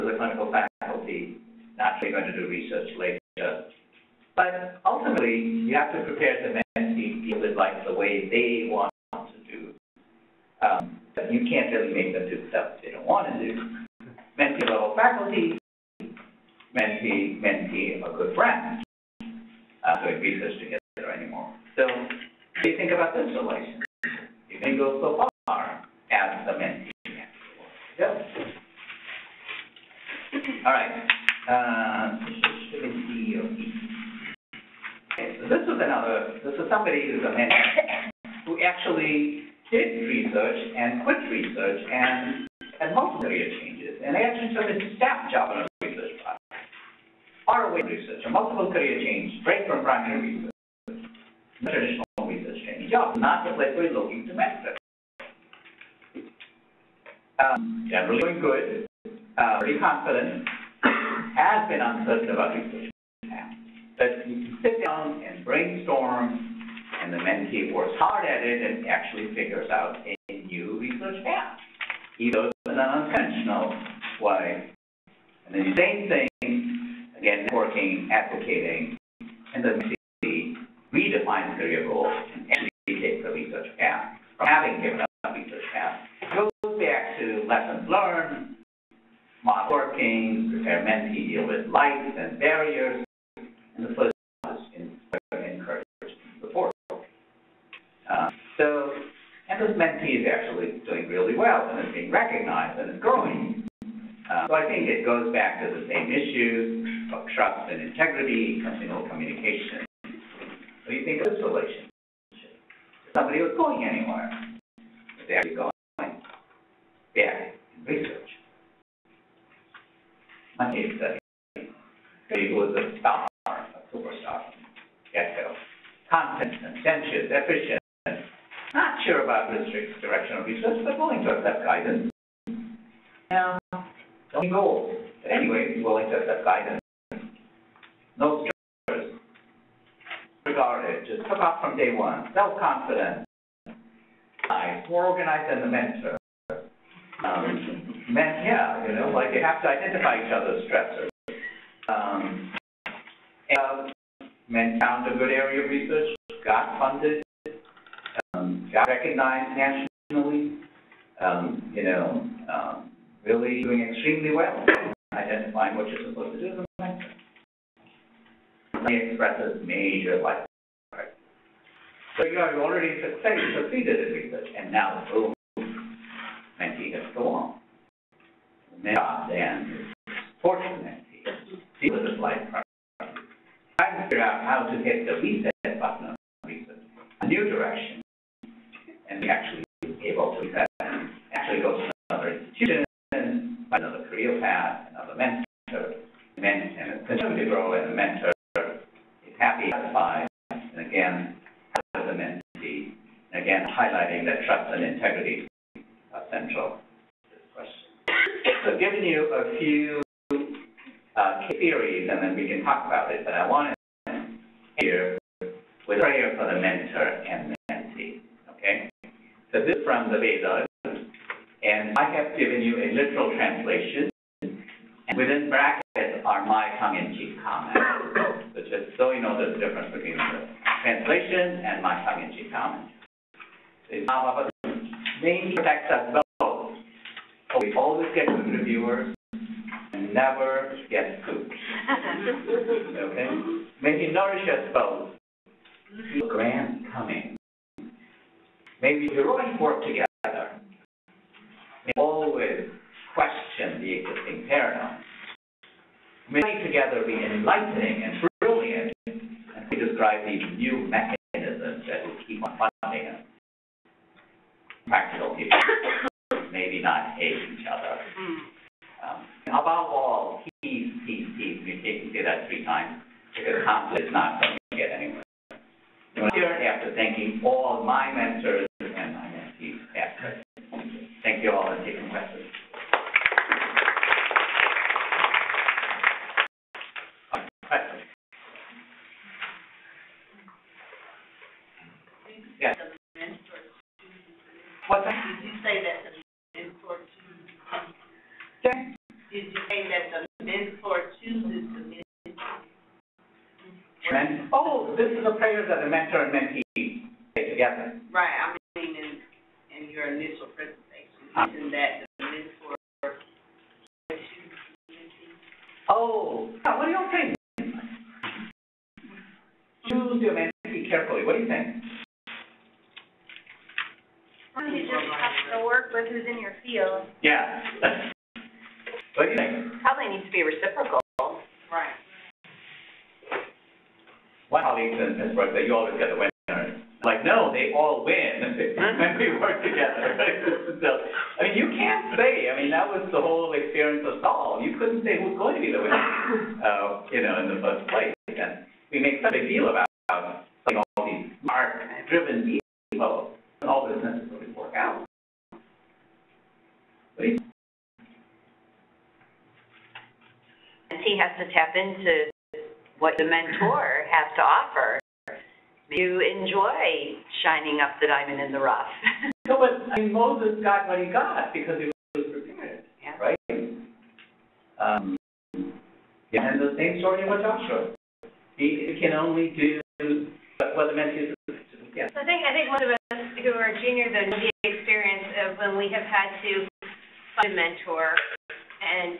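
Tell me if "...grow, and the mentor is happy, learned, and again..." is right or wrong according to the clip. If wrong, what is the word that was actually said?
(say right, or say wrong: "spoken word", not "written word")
wrong: "satisfied", not "learned".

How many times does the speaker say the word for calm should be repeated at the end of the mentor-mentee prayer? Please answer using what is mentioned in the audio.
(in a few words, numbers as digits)
3.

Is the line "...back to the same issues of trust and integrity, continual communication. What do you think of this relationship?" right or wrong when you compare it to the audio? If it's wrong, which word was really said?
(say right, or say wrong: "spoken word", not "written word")
right.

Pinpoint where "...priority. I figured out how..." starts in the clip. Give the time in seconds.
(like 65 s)
182 s.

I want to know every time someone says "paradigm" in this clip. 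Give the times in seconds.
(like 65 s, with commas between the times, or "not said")
254 s.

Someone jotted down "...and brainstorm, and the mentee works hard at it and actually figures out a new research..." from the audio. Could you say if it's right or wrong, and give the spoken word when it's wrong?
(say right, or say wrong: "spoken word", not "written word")
right.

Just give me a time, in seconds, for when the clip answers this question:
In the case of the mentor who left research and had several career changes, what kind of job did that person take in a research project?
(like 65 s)
44 s.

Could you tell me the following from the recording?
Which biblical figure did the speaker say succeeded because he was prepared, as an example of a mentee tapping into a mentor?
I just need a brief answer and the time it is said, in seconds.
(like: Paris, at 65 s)
Moses, at 370 s.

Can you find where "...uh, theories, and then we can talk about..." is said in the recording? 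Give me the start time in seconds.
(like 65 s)
211 s.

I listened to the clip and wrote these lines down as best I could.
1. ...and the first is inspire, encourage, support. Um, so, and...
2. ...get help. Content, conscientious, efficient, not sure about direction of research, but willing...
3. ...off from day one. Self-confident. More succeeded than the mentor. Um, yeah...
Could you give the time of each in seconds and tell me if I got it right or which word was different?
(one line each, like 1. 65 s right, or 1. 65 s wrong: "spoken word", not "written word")
1. 93 s right
2. 125 s right
3. 141 s wrong: "organized", not "succeeded".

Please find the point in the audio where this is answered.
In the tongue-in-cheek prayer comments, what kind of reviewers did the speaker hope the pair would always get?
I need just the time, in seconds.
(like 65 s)
238 s.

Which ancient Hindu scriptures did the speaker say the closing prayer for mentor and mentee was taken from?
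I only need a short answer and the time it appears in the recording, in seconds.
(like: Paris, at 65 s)
the Vedas, at 220 s.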